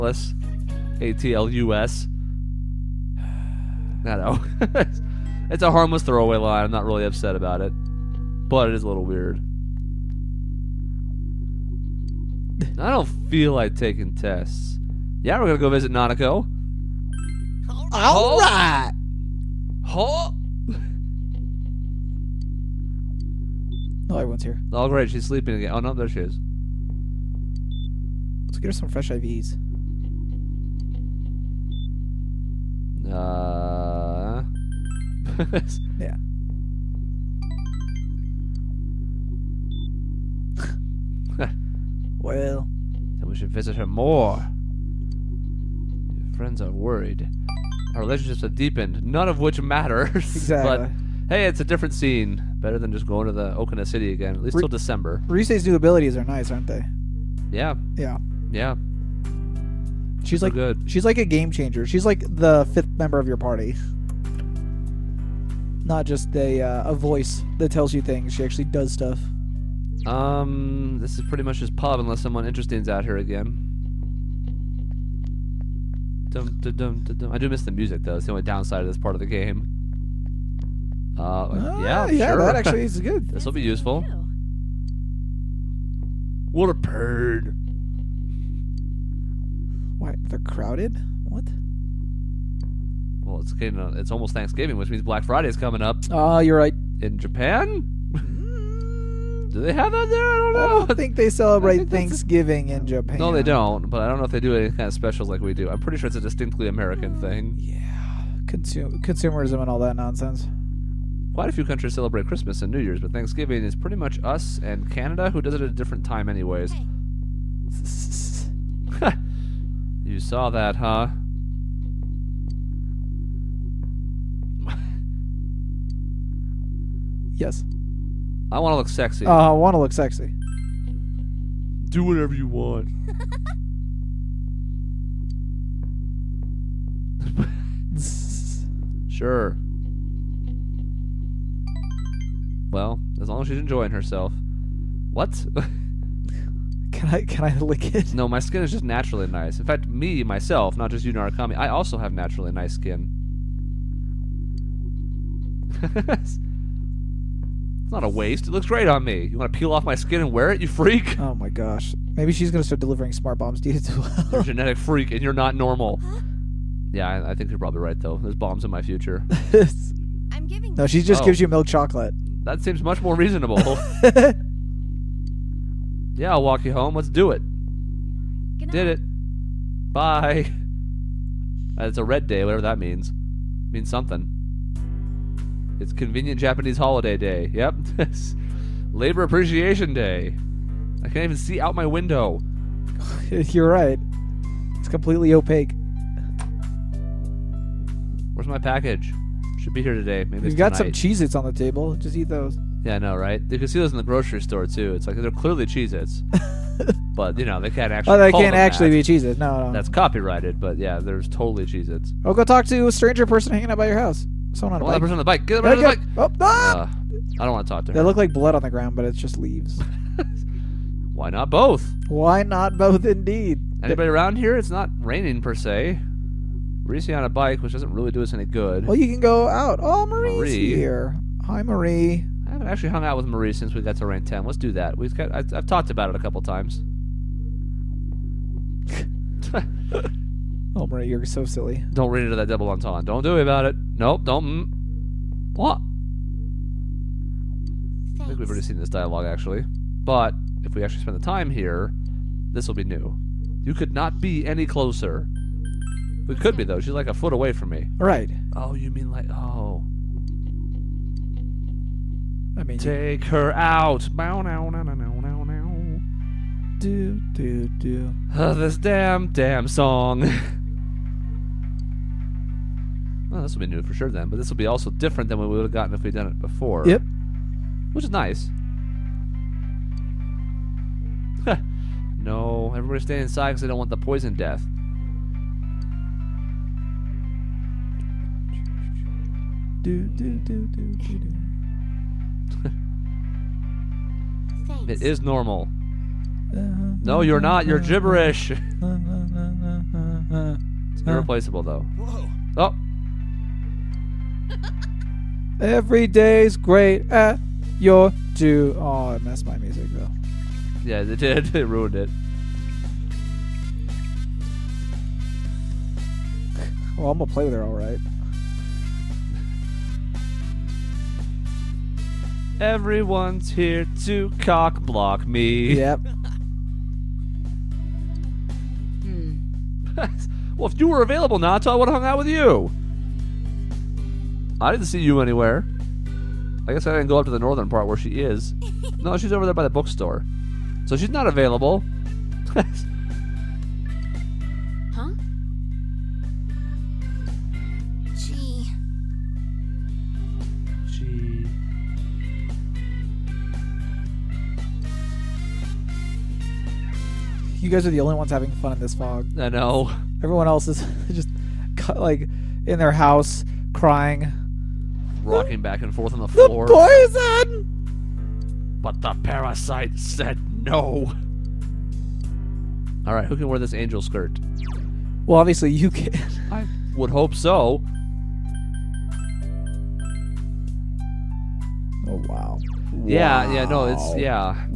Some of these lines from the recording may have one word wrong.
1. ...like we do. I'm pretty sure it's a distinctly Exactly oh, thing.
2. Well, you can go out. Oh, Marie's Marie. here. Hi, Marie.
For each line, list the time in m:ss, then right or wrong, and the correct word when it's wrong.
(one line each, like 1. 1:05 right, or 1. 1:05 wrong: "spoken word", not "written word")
1. 1:45 wrong: "American", not "Exactly"
2. 3:48 right.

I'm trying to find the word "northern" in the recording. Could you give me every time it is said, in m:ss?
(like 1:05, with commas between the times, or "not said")
5:37.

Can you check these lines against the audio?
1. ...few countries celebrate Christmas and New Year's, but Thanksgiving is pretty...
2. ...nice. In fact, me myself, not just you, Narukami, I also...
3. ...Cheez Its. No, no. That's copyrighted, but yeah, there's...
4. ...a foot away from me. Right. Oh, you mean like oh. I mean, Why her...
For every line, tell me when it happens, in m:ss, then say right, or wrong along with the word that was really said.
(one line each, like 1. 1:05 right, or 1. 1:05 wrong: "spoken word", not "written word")
1. 1:51 right
2. 2:29 right
3. 3:29 right
4. 4:17 wrong: "Take", not "Why".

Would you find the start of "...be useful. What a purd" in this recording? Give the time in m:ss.
1:23.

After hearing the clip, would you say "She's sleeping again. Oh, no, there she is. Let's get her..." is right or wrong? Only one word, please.
right.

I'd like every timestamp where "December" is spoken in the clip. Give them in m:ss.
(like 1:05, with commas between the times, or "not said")
0:54.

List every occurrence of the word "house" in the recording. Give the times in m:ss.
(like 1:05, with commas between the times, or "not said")
3:33, 6:02.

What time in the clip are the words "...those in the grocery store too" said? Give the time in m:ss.
3:23.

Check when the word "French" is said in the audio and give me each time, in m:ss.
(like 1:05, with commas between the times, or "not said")
not said.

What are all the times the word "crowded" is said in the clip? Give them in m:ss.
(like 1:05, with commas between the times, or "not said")
1:30.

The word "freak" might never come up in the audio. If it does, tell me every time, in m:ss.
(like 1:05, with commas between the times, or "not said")
2:40, 2:44.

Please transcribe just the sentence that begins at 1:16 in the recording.
Dum, dum, dum, I do miss the music though.